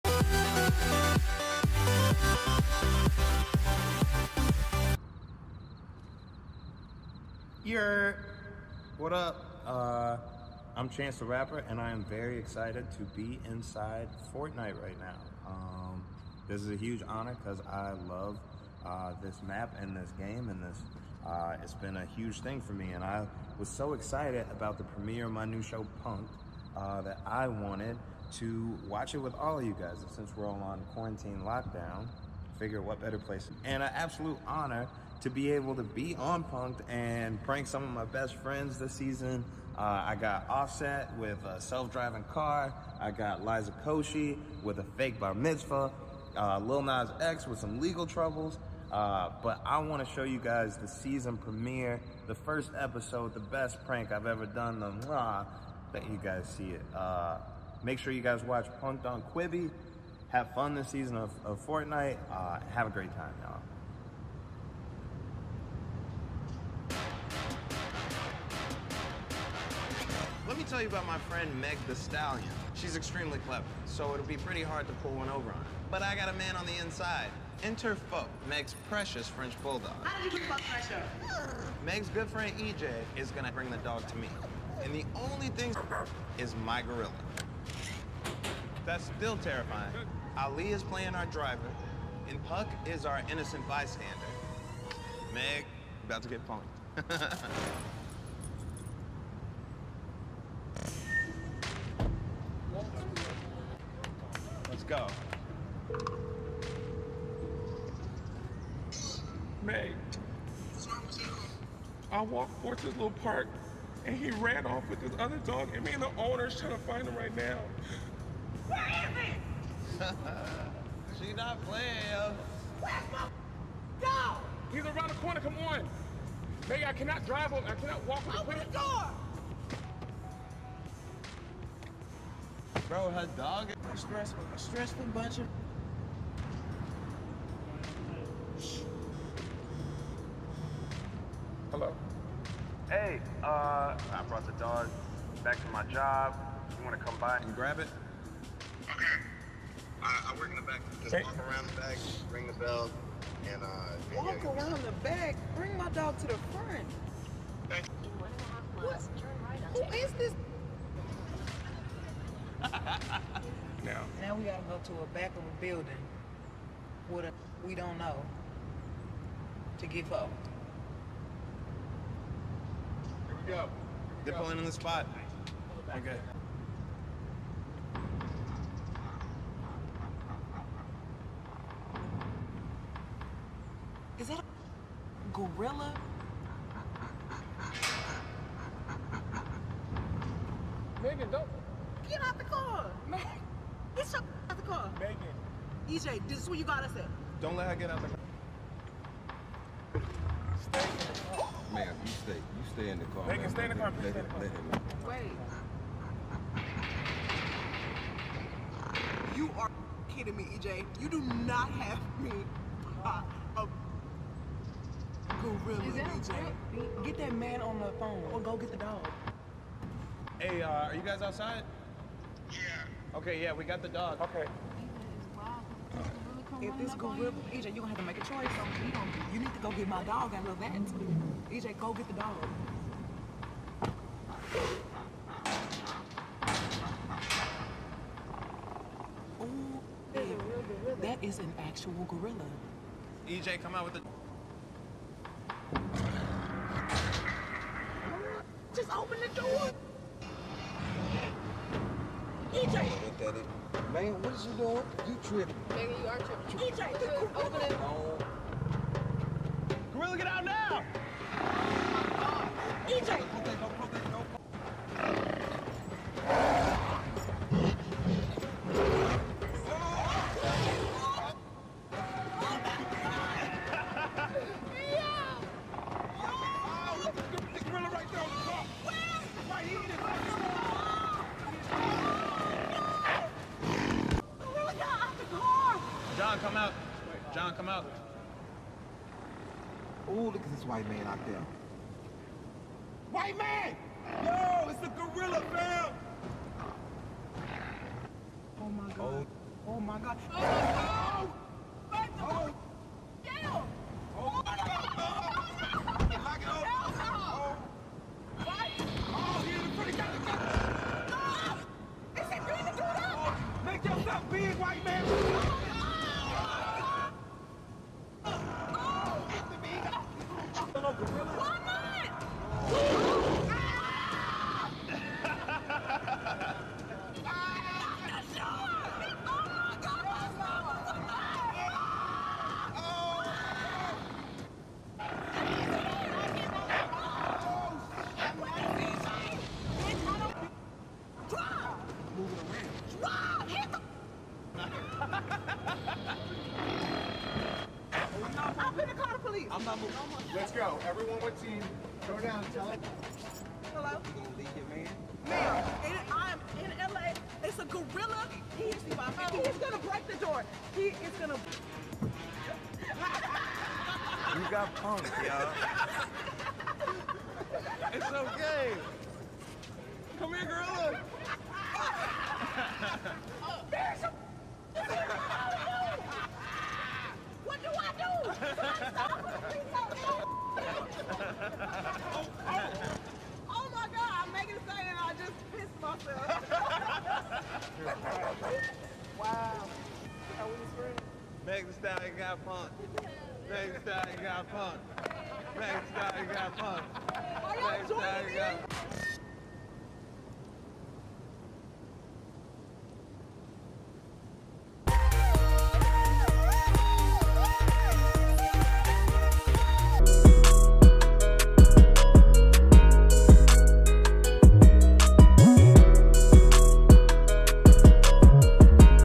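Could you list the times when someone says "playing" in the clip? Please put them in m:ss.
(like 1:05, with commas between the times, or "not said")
1:30, 2:01.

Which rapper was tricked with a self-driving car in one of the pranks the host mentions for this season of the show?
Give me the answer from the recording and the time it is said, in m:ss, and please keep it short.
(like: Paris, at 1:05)
Offset, at 0:40.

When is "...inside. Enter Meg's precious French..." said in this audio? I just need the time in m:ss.
1:16.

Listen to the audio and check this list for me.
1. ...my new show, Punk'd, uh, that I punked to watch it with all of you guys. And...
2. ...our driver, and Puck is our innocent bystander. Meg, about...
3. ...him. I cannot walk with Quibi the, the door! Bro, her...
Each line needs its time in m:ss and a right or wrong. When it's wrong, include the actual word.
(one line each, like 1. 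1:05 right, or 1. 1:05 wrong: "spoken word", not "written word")
1. 0:25 wrong: "wanted", not "punked"
2. 1:31 right
3. 2:07 wrong: "Open", not "Quibi".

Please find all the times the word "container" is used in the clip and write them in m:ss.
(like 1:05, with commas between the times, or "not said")
not said.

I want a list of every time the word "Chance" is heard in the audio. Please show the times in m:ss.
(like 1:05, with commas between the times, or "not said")
0:10.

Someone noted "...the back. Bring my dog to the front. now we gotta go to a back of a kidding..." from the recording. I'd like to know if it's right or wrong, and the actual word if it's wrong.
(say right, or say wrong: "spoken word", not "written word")
wrong: "building", not "kidding".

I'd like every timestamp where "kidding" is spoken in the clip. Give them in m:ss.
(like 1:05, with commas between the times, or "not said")
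3:30.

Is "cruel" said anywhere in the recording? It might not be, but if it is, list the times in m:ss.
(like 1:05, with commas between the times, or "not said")
not said.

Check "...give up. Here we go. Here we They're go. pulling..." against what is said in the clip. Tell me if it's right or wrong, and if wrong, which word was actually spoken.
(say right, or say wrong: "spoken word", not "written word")
right.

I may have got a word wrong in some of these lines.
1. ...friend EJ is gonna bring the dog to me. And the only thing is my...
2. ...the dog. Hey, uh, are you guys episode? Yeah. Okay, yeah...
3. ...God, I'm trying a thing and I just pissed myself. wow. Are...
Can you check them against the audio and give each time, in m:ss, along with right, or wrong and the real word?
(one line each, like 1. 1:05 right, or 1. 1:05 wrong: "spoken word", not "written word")
1. 1:22 right
2. 3:38 wrong: "outside", not "episode"
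3. 6:23 wrong: "making", not "trying".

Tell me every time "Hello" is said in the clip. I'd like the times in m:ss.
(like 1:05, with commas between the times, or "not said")
2:21, 5:53.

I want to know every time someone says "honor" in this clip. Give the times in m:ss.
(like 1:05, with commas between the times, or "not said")
0:17, 0:34.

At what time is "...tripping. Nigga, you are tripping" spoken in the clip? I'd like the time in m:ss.
4:15.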